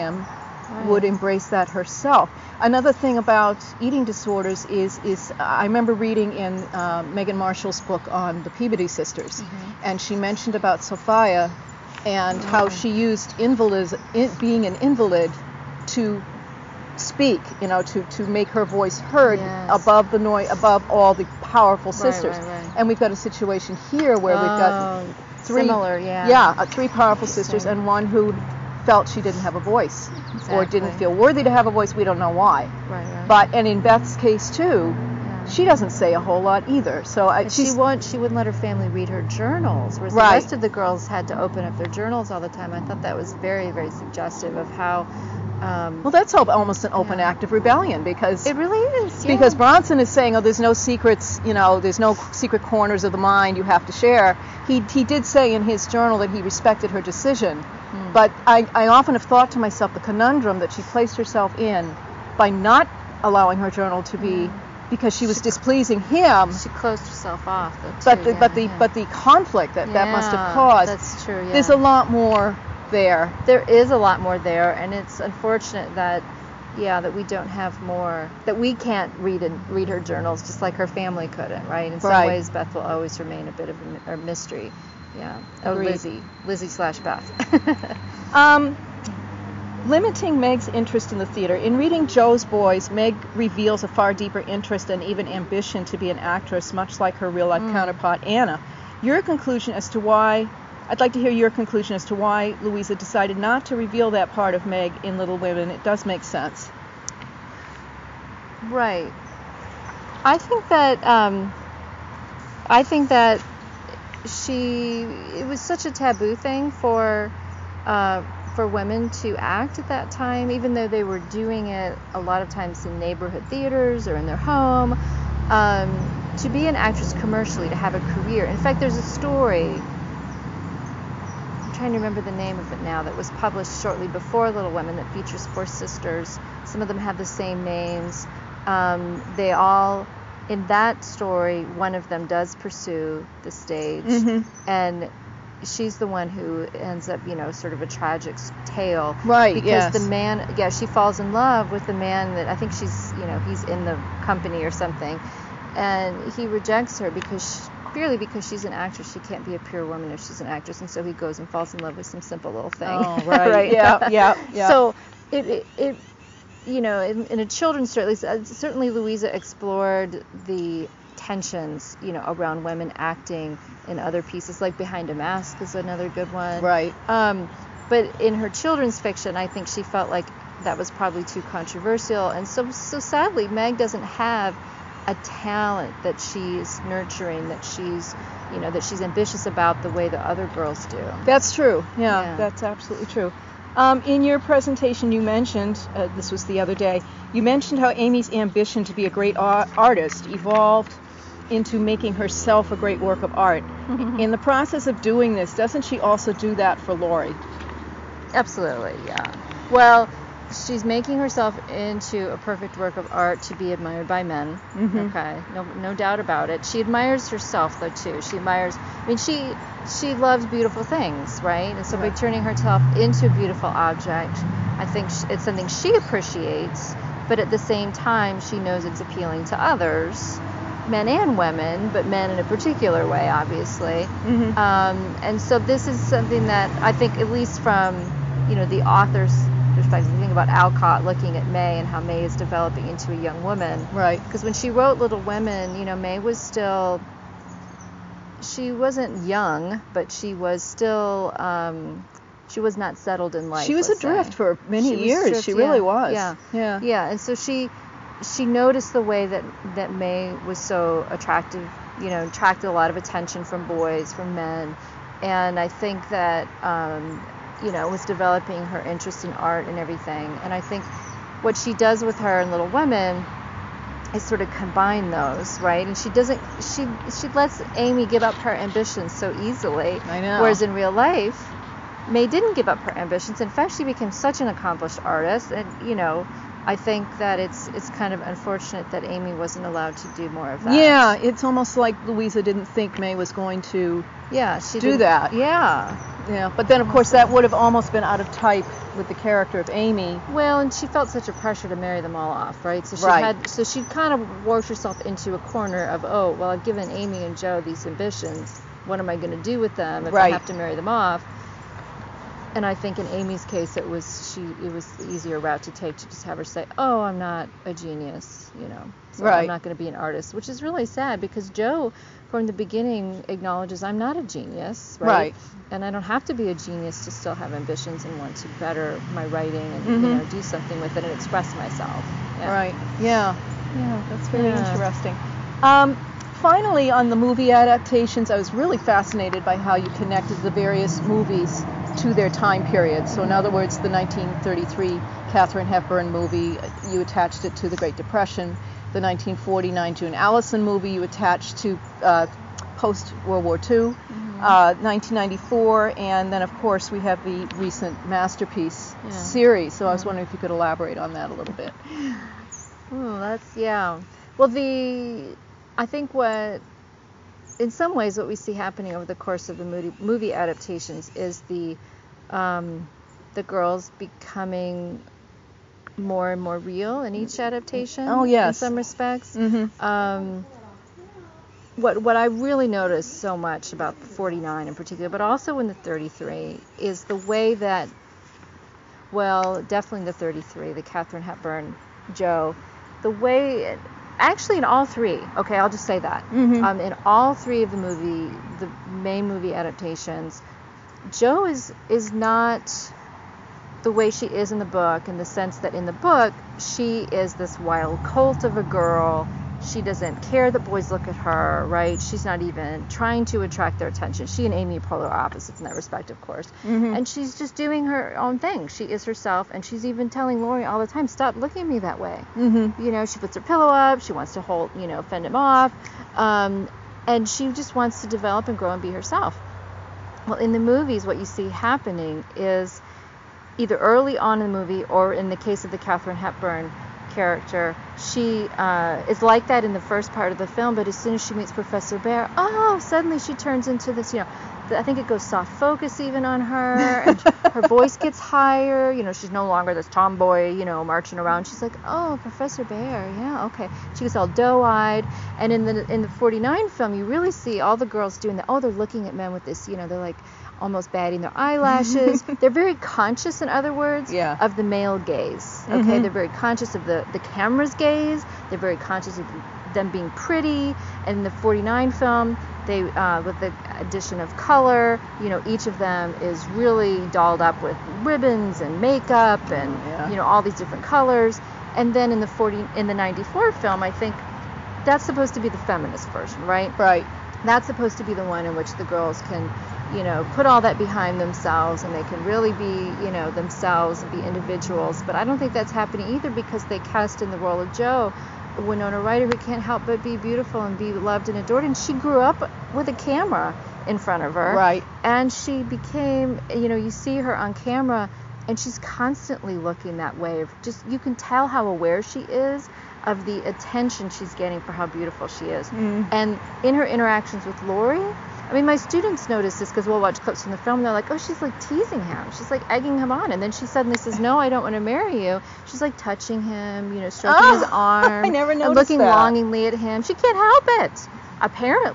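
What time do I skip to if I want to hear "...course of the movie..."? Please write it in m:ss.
6:09.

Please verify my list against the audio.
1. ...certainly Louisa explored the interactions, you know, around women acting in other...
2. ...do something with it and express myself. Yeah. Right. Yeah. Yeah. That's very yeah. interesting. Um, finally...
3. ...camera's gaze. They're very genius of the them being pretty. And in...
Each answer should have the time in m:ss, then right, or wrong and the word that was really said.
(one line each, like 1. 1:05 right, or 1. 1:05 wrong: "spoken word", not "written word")
1. 2:48 wrong: "tensions", not "interactions"
2. 5:30 right
3. 7:47 wrong: "conscious", not "genius".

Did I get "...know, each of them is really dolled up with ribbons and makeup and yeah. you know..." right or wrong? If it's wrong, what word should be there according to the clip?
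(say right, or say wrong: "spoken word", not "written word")
right.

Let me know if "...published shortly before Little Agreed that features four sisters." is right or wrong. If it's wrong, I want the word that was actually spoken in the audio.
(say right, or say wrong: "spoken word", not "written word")
wrong: "Women", not "Agreed".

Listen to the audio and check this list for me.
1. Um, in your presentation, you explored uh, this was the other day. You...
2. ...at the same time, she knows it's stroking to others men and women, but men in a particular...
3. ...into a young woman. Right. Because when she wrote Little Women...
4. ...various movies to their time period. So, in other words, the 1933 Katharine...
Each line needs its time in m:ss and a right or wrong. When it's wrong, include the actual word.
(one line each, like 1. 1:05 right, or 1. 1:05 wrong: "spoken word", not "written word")
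1. 3:13 wrong: "mentioned", not "explored"
2. 3:47 wrong: "appealing", not "stroking"
3. 4:02 right
4. 5:40 right.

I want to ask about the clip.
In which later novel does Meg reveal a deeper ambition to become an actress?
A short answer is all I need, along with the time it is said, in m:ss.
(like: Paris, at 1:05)
Jo's Boys, at 1:32.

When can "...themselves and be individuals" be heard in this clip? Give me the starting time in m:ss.
8:13.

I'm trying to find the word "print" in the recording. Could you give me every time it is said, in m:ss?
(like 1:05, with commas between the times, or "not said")
not said.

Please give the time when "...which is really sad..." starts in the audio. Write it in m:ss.
5:20.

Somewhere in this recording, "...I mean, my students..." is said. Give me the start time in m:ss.
8:38.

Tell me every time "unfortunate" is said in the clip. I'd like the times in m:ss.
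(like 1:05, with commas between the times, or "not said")
1:15, 4:48.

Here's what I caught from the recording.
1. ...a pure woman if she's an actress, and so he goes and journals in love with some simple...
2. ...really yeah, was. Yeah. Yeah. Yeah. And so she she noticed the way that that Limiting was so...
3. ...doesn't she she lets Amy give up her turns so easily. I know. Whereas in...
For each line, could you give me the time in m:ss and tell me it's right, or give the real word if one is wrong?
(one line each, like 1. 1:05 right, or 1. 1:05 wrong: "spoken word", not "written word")
1. 2:39 wrong: "falls", not "journals"
2. 4:15 wrong: "May", not "Limiting"
3. 4:36 wrong: "ambitions", not "turns".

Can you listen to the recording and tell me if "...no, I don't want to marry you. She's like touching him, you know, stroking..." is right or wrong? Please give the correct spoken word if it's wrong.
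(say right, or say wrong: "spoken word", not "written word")
right.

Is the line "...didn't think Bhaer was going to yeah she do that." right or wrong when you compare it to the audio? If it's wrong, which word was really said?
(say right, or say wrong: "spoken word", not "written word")
wrong: "May", not "Bhaer".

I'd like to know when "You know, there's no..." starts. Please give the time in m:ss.
0:51.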